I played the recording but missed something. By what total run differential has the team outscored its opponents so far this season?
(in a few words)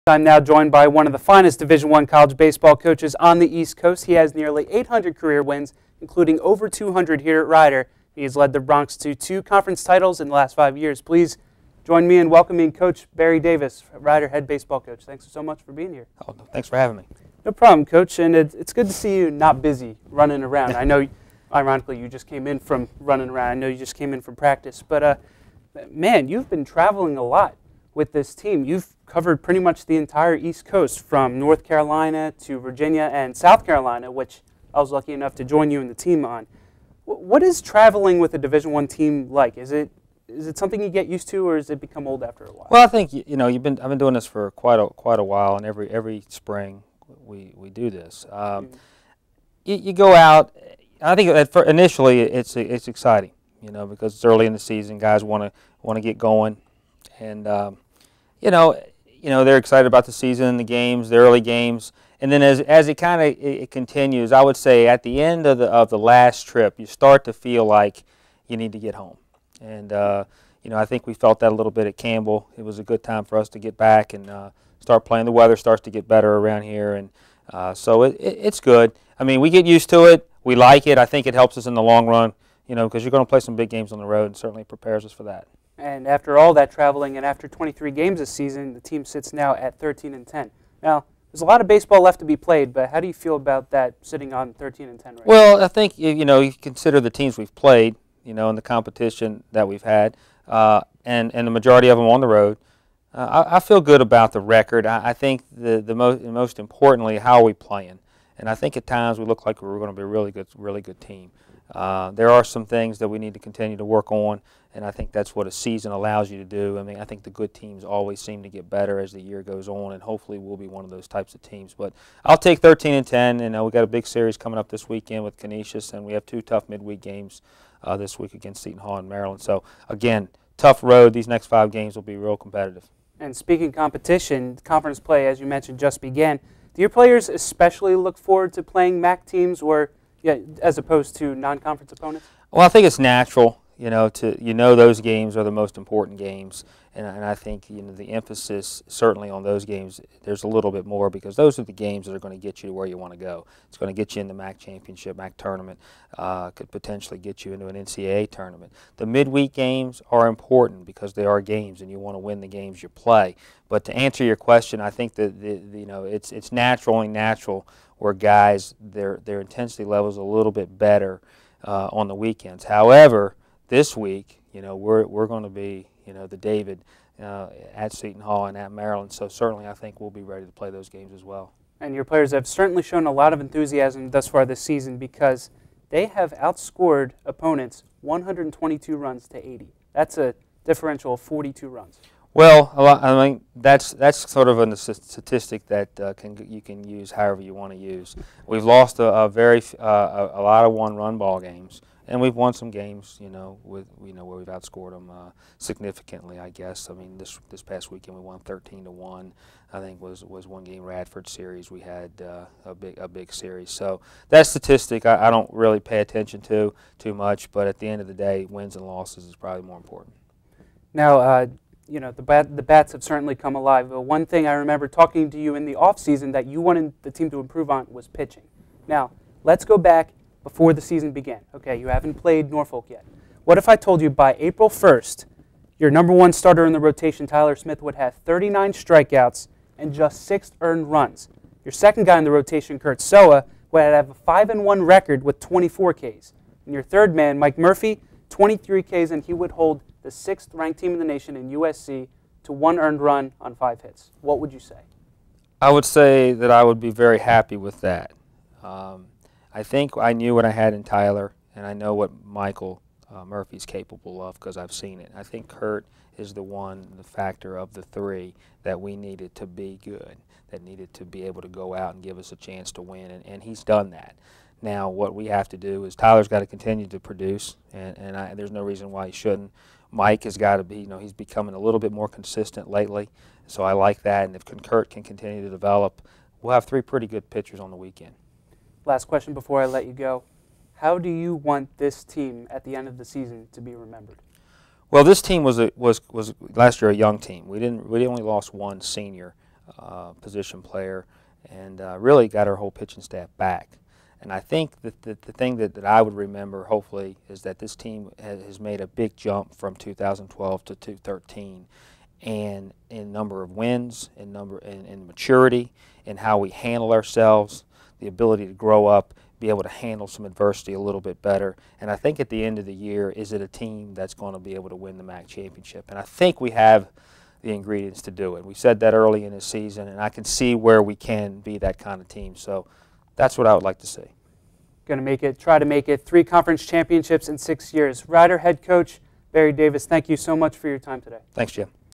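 42.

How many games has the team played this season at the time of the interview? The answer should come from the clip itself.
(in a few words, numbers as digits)
23.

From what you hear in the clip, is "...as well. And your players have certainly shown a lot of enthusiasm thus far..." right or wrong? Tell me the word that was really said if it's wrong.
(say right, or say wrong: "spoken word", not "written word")
right.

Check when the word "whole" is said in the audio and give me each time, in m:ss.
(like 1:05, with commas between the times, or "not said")
5:02.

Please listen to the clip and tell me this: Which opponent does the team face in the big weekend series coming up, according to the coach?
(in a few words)
Canisius.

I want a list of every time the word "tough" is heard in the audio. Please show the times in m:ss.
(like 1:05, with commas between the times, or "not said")
2:06, 2:10.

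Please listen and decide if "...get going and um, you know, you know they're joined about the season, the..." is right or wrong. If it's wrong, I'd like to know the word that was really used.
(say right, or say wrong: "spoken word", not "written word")
wrong: "excited", not "joined".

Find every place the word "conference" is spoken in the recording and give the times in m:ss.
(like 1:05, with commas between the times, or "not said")
0:09, 2:14, 2:21, 5:36.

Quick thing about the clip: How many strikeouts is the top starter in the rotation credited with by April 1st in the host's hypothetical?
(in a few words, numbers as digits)
39.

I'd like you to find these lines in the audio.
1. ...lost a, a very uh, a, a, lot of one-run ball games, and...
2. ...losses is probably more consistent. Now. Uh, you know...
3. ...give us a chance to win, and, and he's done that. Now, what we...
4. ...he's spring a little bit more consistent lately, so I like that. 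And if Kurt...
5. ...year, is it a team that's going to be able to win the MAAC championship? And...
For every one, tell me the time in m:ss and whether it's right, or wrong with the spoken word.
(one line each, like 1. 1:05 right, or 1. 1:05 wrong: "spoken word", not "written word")
1. 3:18 right
2. 3:38 wrong: "important", not "consistent"
3. 4:32 right
4. 4:40 wrong: "becoming", not "spring"
5. 5:22 right.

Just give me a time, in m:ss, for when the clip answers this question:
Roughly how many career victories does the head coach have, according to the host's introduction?
0:04.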